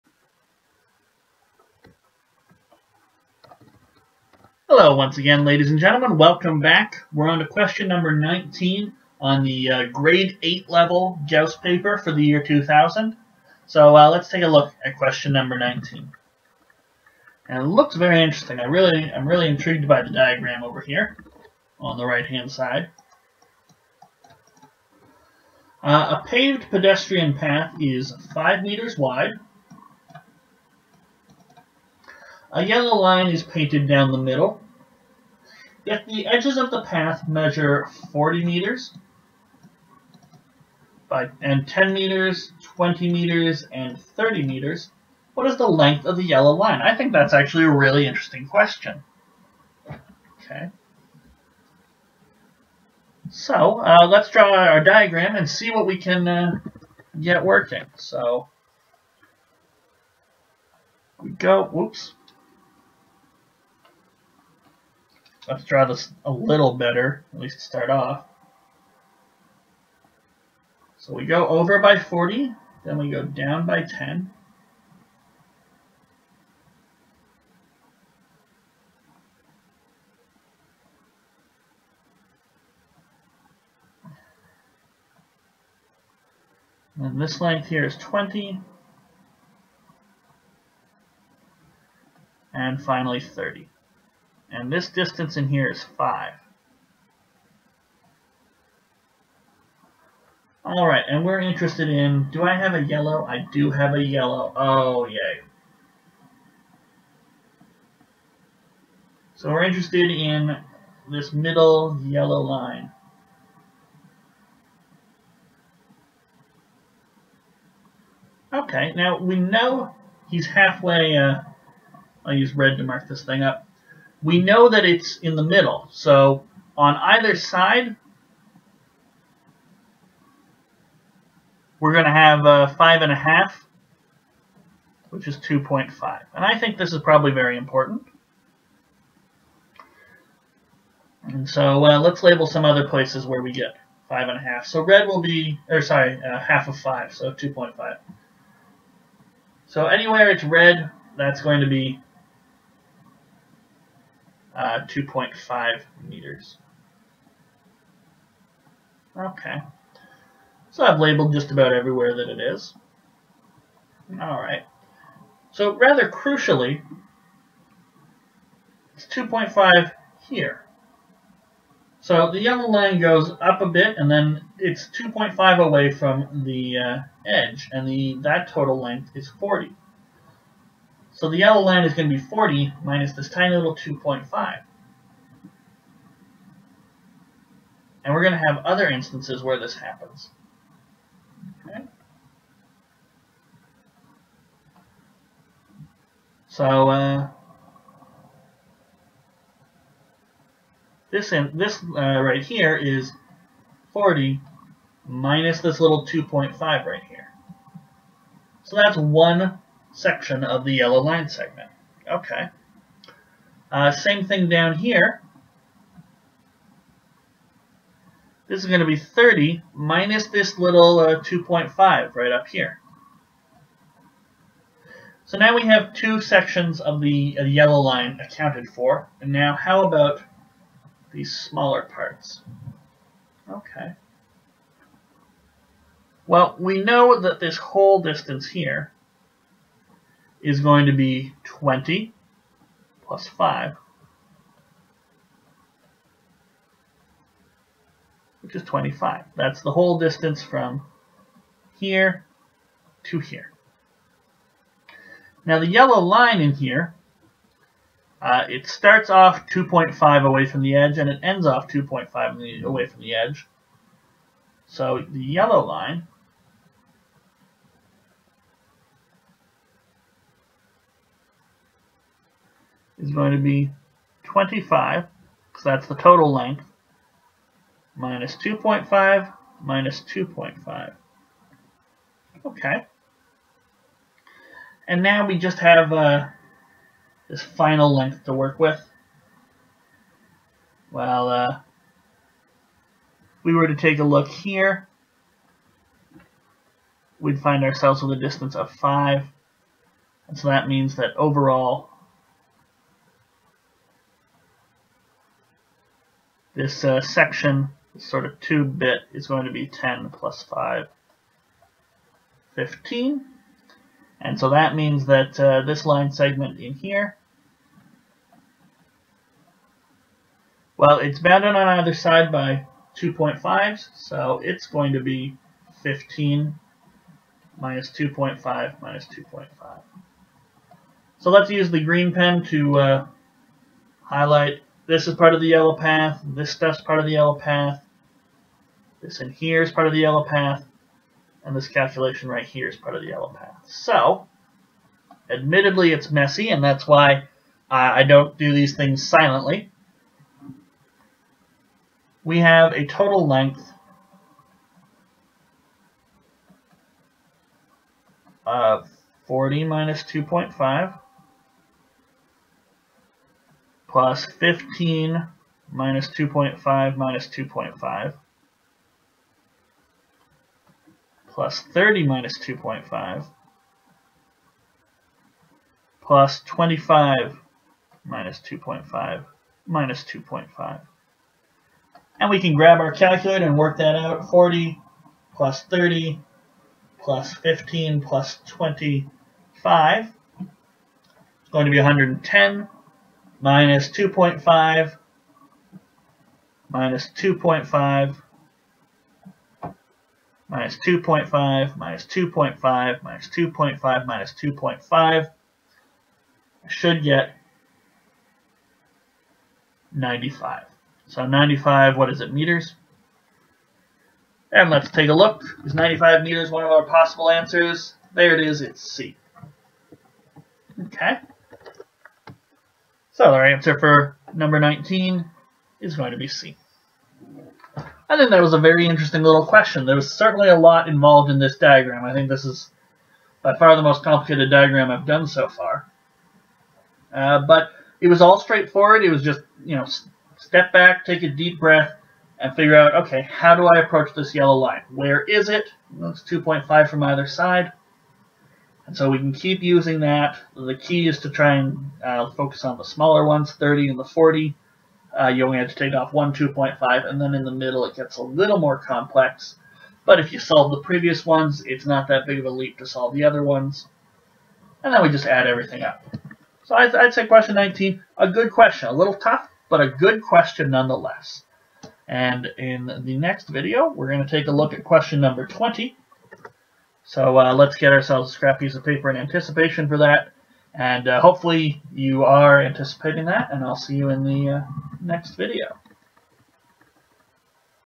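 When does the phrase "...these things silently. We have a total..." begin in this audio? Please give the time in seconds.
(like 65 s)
348 s.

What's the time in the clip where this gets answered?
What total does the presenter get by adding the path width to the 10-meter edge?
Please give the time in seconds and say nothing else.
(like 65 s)
310 s.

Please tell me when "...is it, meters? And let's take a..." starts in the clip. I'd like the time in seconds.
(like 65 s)
412 s.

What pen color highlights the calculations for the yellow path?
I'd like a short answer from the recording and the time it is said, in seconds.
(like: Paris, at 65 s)
green, at 331 s.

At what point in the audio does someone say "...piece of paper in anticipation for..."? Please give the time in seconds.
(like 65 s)
478 s.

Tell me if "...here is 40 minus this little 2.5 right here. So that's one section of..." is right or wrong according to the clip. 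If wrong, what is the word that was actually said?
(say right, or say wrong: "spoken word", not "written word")
right.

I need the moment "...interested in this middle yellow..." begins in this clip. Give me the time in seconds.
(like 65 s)
109 s.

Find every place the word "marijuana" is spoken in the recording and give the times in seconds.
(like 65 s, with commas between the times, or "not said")
not said.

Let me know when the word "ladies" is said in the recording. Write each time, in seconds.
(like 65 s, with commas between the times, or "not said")
5 s.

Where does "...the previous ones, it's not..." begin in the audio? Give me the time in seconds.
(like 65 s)
460 s.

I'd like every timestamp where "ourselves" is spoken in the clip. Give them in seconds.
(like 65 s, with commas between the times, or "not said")
297 s, 477 s.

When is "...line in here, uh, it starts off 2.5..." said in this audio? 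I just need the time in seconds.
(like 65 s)
256 s.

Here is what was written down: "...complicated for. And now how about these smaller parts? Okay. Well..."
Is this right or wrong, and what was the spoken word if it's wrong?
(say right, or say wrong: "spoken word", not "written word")
wrong: "accounted", not "complicated".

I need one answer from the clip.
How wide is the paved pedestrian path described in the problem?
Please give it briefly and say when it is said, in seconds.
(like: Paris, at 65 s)
5 meters, at 28 s.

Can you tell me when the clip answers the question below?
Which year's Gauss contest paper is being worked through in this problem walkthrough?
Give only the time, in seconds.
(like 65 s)
12 s.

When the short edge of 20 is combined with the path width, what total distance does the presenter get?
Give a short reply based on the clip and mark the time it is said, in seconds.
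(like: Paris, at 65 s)
25, at 241 s.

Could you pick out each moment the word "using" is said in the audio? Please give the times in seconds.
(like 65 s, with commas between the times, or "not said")
449 s.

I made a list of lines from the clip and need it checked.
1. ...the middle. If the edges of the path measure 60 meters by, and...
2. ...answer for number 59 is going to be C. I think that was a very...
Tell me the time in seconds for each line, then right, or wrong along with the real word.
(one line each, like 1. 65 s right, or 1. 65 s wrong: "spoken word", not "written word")
1. 34 s wrong: "40", not "60"
2. 423 s wrong: "19", not "59".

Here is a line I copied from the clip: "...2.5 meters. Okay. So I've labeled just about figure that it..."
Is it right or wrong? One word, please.
wrong.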